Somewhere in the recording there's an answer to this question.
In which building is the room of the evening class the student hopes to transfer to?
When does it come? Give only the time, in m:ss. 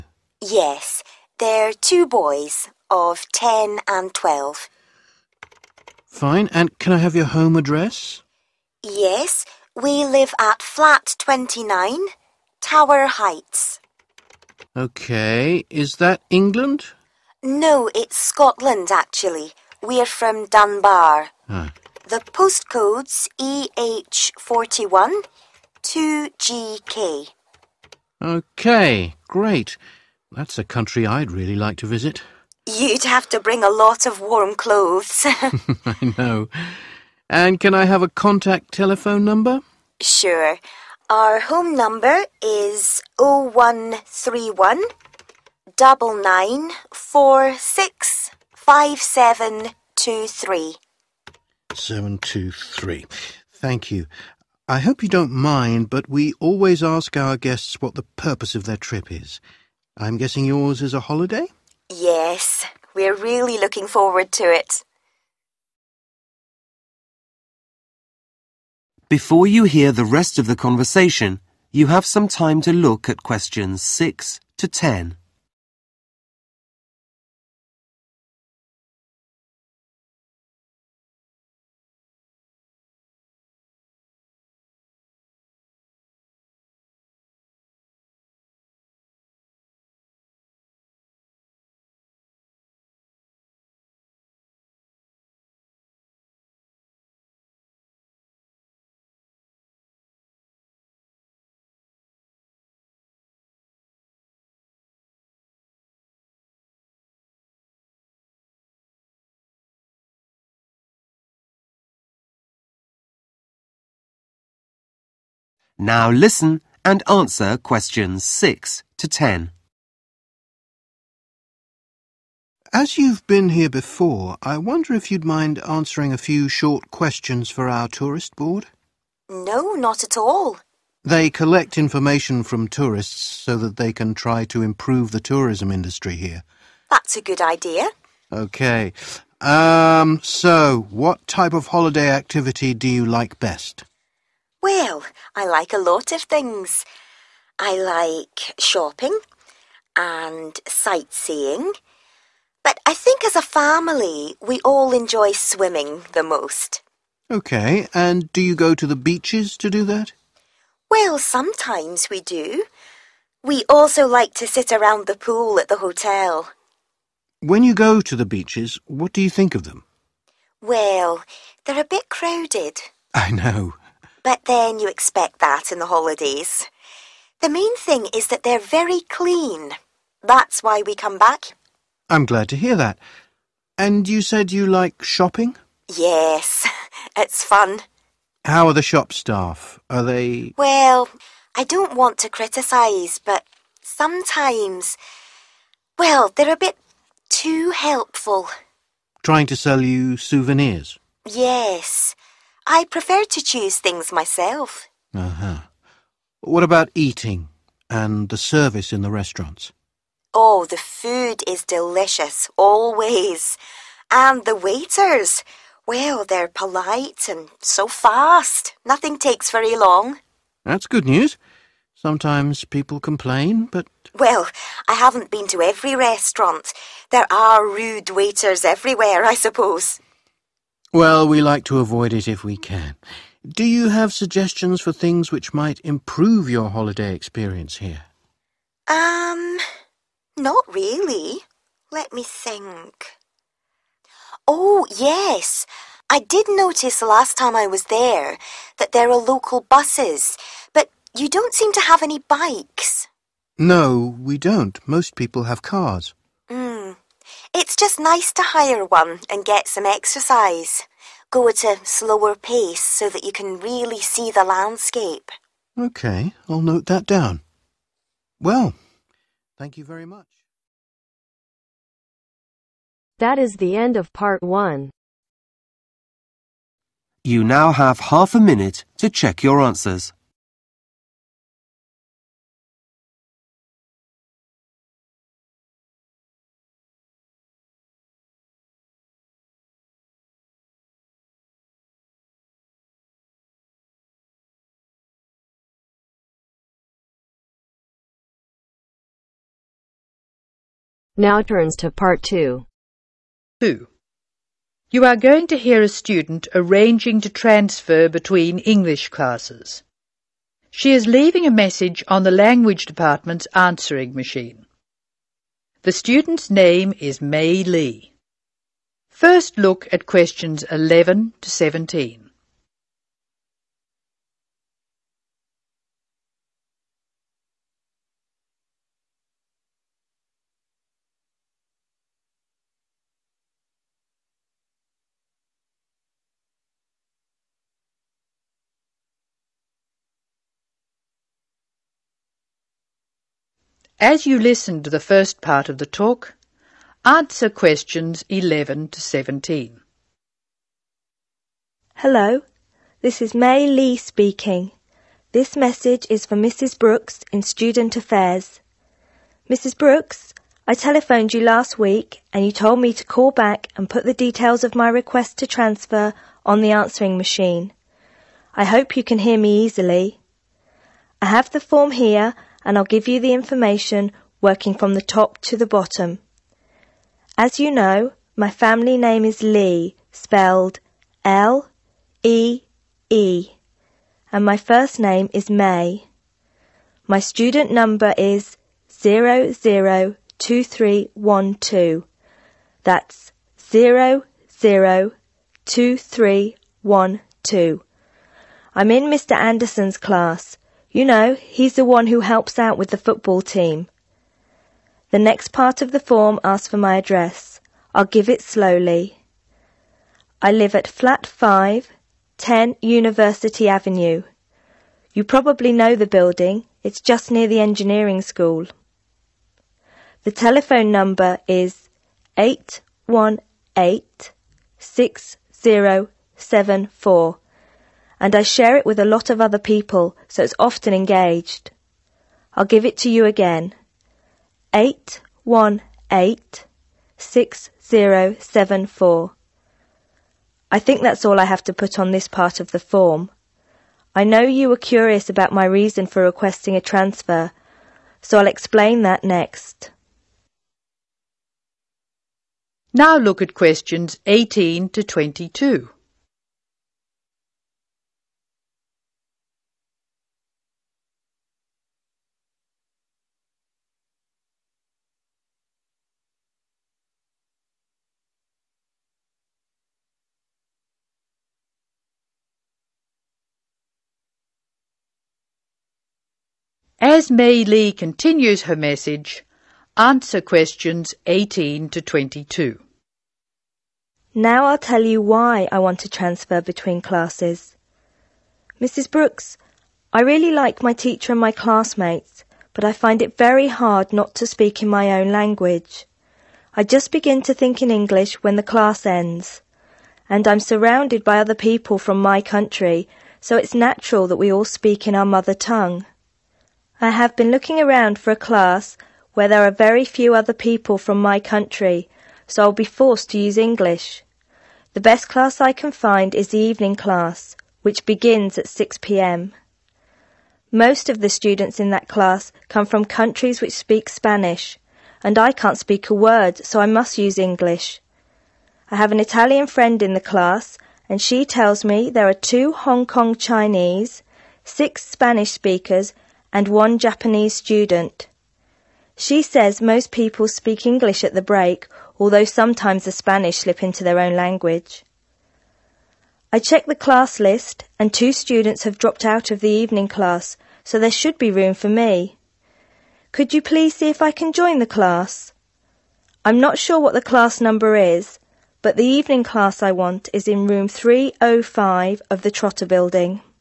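9:22.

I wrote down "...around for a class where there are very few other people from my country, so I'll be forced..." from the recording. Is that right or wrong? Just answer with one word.
right.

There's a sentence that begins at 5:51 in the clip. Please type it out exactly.
Hello, this is May Lee speaking.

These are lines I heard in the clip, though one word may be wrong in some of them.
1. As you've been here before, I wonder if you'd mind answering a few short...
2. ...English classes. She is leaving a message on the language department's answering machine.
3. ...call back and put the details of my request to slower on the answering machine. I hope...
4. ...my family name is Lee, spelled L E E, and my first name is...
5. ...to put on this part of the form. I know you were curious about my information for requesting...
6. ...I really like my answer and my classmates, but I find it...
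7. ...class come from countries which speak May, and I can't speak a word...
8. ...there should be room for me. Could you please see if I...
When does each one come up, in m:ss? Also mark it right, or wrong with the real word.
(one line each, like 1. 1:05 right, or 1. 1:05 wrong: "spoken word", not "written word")
1. 2:02 right
2. 5:08 right
3. 6:03 wrong: "transfer", not "slower"
4. 6:18 right
5. 7:21 wrong: "reason", not "information"
6. 8:10 wrong: "teacher", not "answer"
7. 8:42 wrong: "Spanish", not "May"
8. 9:10 right.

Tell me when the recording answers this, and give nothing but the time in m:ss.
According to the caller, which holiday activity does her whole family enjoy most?
2:35.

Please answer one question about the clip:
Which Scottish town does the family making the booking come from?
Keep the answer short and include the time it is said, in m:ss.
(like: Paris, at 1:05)
Dunbar, at 0:20.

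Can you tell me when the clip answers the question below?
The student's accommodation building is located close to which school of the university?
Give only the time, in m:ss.
6:57.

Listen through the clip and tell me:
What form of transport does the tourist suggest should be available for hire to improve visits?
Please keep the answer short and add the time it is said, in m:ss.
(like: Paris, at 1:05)
bikes, at 4:12.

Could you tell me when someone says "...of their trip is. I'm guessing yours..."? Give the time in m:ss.
0:58.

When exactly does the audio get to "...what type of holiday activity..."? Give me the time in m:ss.
2:20.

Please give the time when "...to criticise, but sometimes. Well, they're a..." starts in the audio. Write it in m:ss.
3:12.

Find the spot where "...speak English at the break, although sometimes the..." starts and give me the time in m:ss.
9:00.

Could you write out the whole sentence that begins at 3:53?
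Do you have suggestions for things which might improve your holiday experience here?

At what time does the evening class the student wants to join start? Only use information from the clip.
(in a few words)
6 pm.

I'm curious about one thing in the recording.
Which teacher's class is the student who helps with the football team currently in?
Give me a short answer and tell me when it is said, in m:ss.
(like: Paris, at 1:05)
Mr. Anderson, at 6:39.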